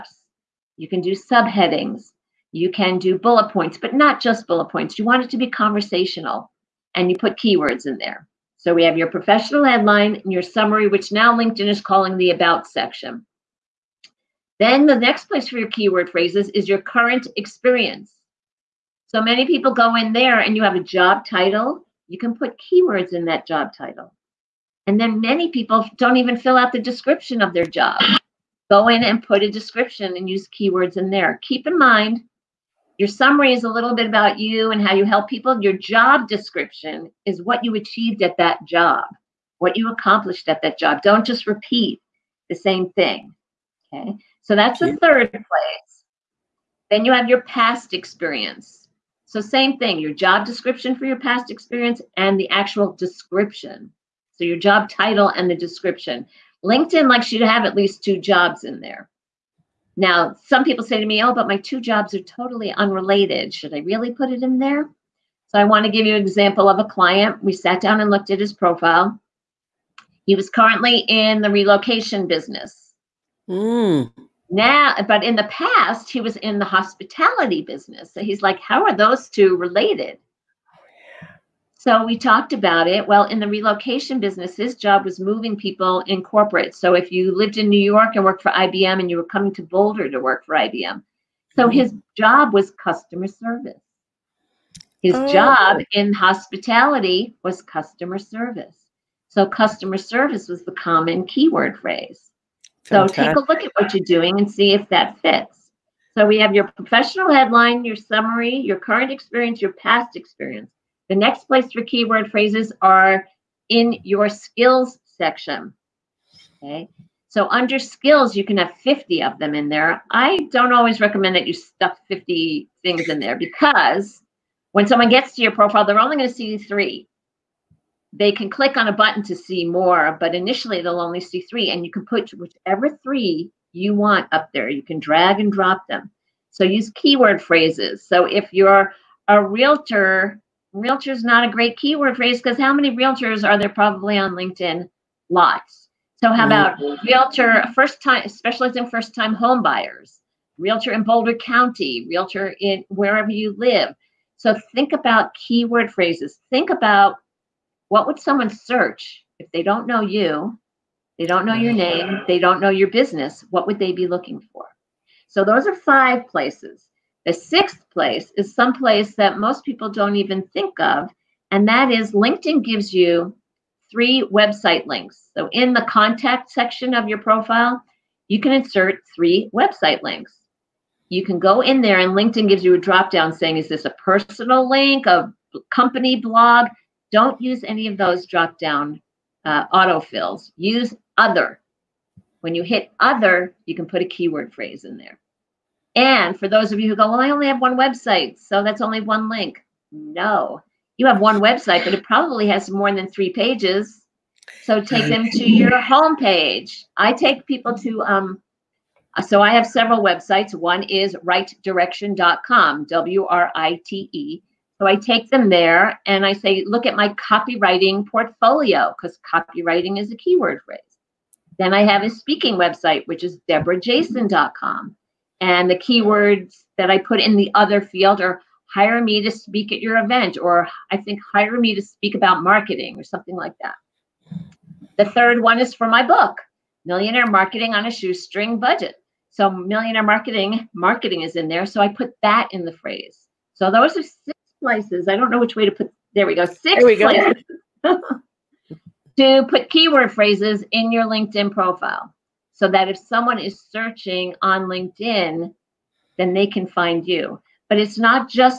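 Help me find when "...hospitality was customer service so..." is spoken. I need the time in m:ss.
1:36.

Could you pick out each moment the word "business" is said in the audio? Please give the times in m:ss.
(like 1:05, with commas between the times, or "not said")
1:12, 1:17, 1:24, 2:42.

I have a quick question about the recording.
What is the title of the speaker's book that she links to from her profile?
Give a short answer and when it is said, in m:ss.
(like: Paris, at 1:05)
Millionaire Marketing on a Shoestring Budget, at 3:56.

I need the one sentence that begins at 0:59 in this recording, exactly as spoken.
Now, some people say to me, oh, but my two jobs are totally unrelated.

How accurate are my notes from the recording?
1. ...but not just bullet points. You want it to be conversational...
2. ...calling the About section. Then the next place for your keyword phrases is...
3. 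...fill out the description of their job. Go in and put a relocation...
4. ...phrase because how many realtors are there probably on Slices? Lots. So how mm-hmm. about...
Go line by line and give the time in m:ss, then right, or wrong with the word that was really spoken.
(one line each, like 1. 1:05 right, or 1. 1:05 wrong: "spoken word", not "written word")
1. 0:03 right
2. 0:11 right
3. 0:26 wrong: "description", not "relocation"
4. 2:22 wrong: "LinkedIn", not "Slices".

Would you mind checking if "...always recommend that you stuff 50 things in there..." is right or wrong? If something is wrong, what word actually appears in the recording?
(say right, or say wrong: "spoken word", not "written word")
right.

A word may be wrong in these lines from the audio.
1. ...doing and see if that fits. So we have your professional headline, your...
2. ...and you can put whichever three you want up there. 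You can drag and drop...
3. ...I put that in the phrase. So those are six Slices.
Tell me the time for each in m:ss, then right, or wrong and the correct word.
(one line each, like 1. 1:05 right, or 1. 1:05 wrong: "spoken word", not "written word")
1. 1:44 right
2. 2:11 right
3. 4:01 right.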